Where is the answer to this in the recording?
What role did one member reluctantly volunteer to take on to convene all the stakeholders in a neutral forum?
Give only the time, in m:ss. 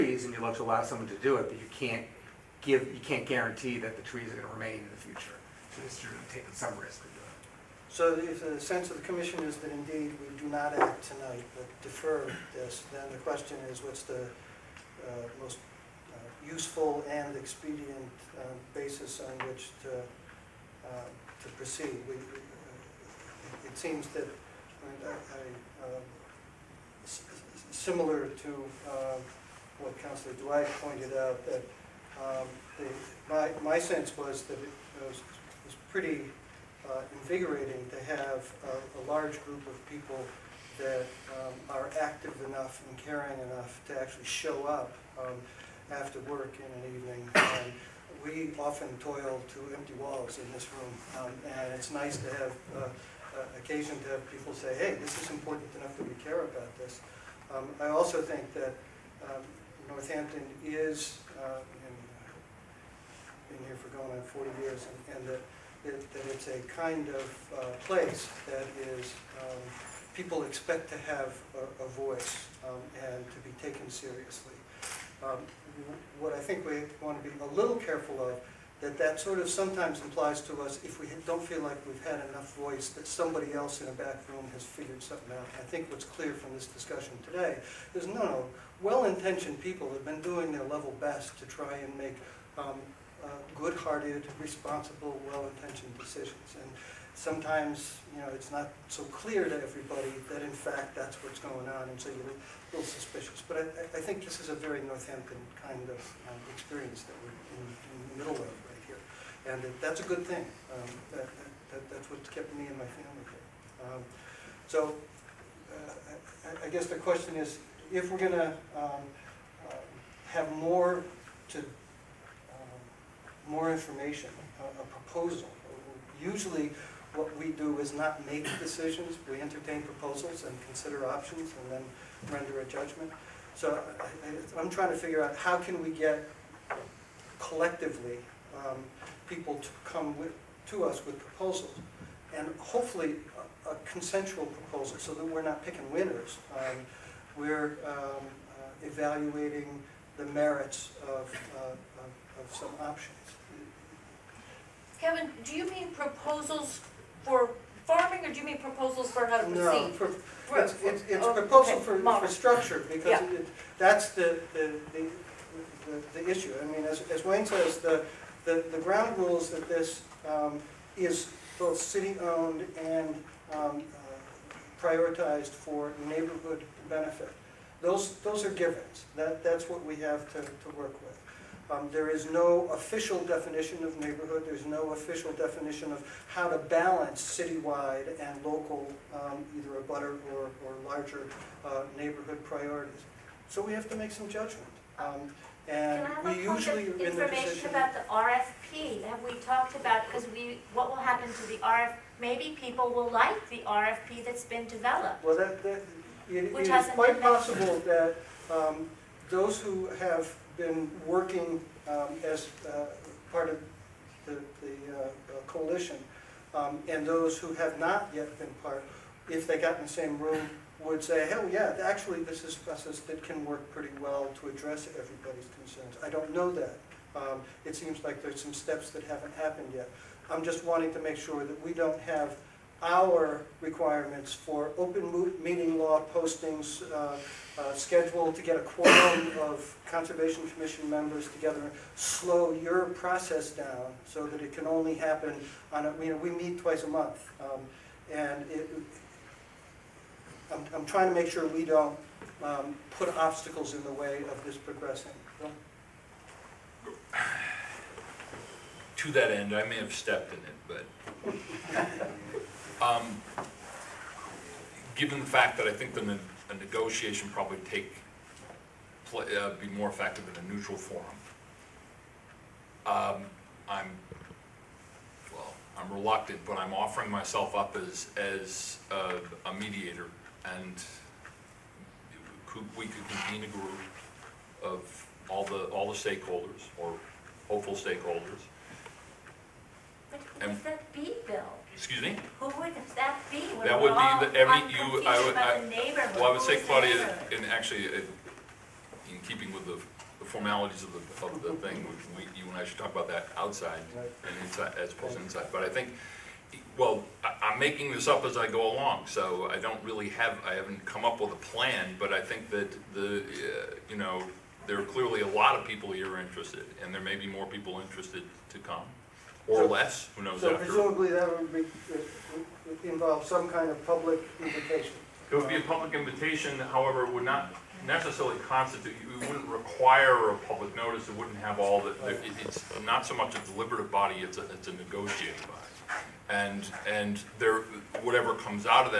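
4:39.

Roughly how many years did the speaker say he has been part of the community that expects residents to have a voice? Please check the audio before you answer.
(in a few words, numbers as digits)
40.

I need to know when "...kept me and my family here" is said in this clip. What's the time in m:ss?
1:52.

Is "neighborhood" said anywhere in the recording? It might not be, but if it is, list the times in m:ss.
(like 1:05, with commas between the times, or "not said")
2:56, 3:03, 3:11.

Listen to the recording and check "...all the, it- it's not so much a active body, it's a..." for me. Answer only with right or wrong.
wrong.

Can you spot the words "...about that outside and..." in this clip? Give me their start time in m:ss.
5:02.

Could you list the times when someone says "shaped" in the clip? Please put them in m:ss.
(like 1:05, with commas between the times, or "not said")
not said.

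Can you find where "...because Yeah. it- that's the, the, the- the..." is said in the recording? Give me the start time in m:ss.
2:42.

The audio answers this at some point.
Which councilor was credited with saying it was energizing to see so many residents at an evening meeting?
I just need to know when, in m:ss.
0:30.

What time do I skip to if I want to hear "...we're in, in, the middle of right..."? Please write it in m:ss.
1:47.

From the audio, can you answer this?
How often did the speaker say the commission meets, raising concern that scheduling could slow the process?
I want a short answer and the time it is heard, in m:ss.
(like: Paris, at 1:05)
twice a month, at 4:06.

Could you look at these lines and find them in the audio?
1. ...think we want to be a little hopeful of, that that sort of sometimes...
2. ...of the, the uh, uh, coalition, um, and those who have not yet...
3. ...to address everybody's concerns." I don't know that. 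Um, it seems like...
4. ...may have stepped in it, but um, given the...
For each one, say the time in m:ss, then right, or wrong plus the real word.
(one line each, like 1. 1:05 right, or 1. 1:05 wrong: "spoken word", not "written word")
1. 1:16 wrong: "careful", not "hopeful"
2. 3:33 right
3. 3:44 right
4. 4:19 right.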